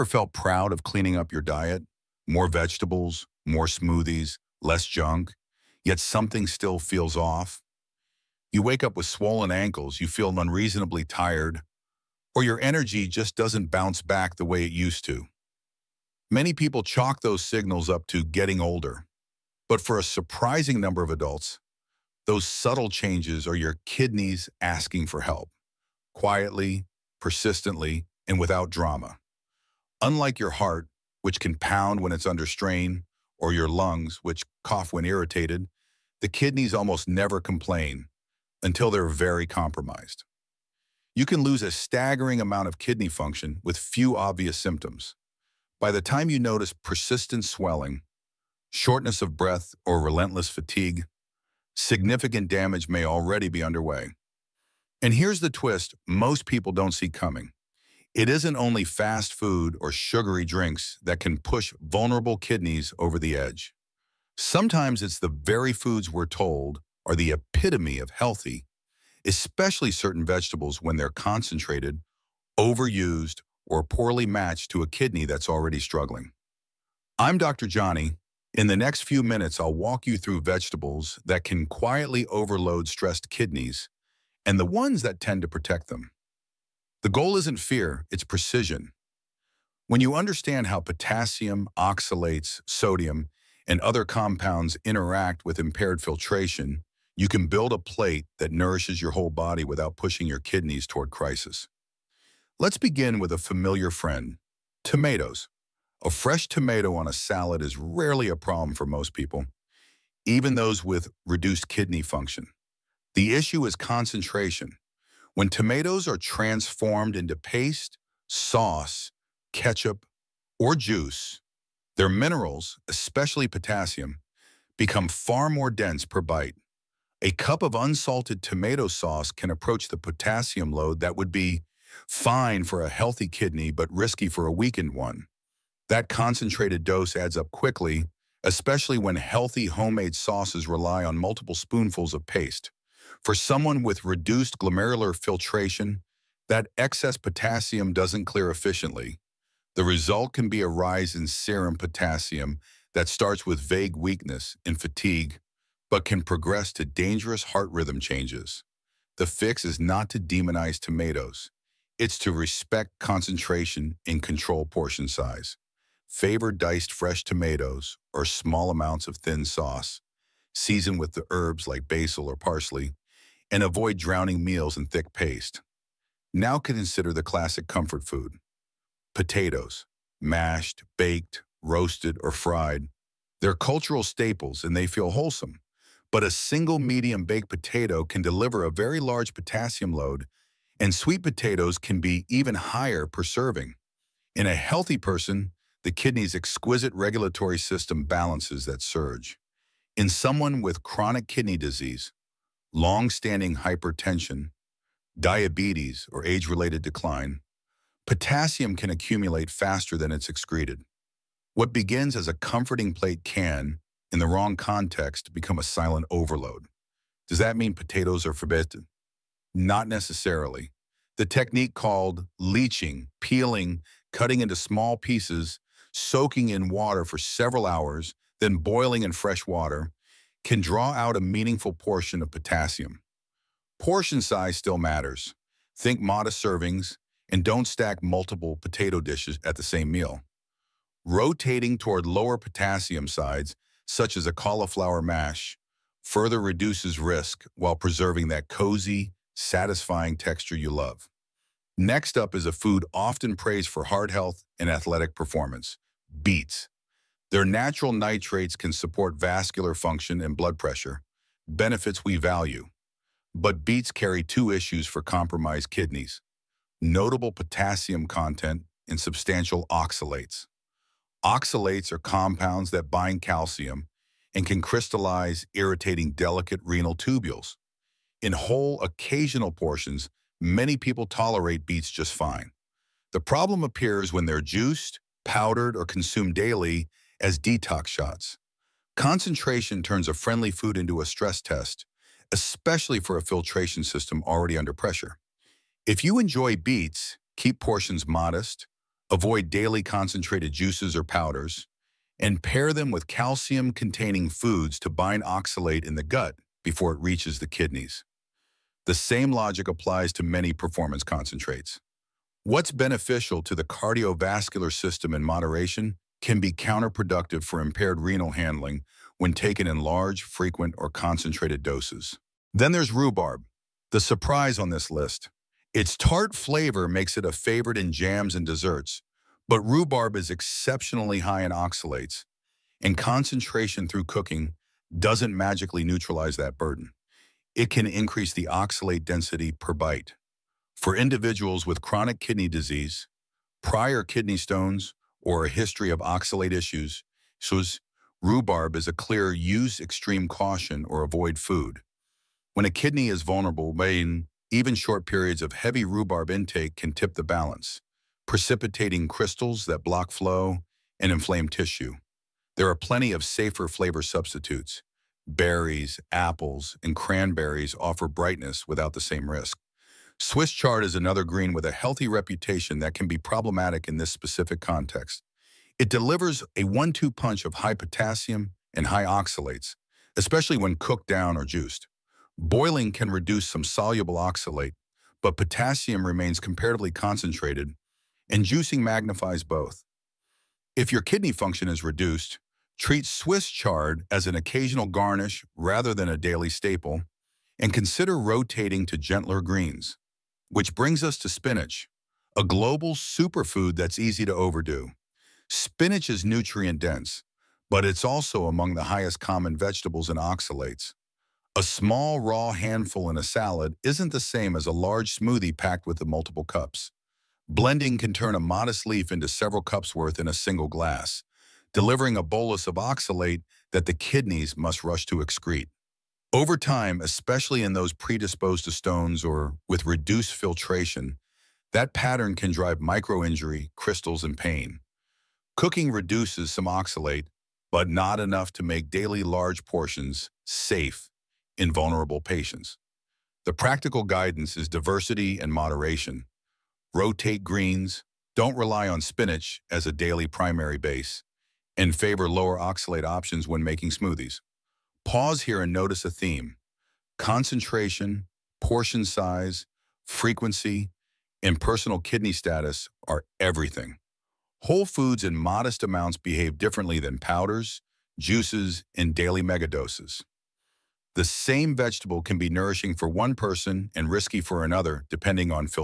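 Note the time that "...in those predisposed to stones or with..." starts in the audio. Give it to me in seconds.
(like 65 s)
427 s.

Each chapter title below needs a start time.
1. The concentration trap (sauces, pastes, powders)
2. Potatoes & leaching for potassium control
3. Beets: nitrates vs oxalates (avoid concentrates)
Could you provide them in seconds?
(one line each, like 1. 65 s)
1. 64 s
2. 181 s
3. 309 s.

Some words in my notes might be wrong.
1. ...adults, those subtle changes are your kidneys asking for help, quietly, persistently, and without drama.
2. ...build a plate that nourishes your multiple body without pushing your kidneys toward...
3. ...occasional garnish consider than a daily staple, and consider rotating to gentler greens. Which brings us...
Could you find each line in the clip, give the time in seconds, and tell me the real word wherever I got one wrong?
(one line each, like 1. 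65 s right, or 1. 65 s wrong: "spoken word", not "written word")
1. 21 s right
2. 97 s wrong: "whole", not "multiple"
3. 394 s wrong: "rather", not "consider".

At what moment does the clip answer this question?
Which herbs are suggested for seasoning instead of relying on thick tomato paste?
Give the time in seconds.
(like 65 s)
171 s.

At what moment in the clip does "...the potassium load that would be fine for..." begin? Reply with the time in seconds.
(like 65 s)
129 s.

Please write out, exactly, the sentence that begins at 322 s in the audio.
Then there's rhubarb, the surprise on this list.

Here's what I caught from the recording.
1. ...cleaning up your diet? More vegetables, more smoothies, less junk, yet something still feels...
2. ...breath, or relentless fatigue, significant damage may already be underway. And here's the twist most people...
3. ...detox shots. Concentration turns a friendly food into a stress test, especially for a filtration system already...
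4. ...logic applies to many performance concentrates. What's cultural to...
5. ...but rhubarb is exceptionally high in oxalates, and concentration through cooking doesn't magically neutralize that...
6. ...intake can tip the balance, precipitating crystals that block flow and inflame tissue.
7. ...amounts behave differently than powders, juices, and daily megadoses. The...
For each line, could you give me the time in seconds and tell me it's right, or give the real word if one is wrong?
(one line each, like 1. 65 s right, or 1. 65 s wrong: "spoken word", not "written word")
1. 0 s right
2. 49 s right
3. 287 s right
4. 309 s wrong: "beneficial", not "cultural"
5. 329 s right
6. 356 s right
7. 465 s right.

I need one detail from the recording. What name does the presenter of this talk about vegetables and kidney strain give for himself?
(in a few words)
Dr. Johnny.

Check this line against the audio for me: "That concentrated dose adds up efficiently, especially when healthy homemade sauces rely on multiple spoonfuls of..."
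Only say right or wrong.
wrong.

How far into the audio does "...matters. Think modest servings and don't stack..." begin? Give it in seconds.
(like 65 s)
234 s.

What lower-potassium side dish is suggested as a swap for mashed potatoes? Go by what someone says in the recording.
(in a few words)
cauliflower mash.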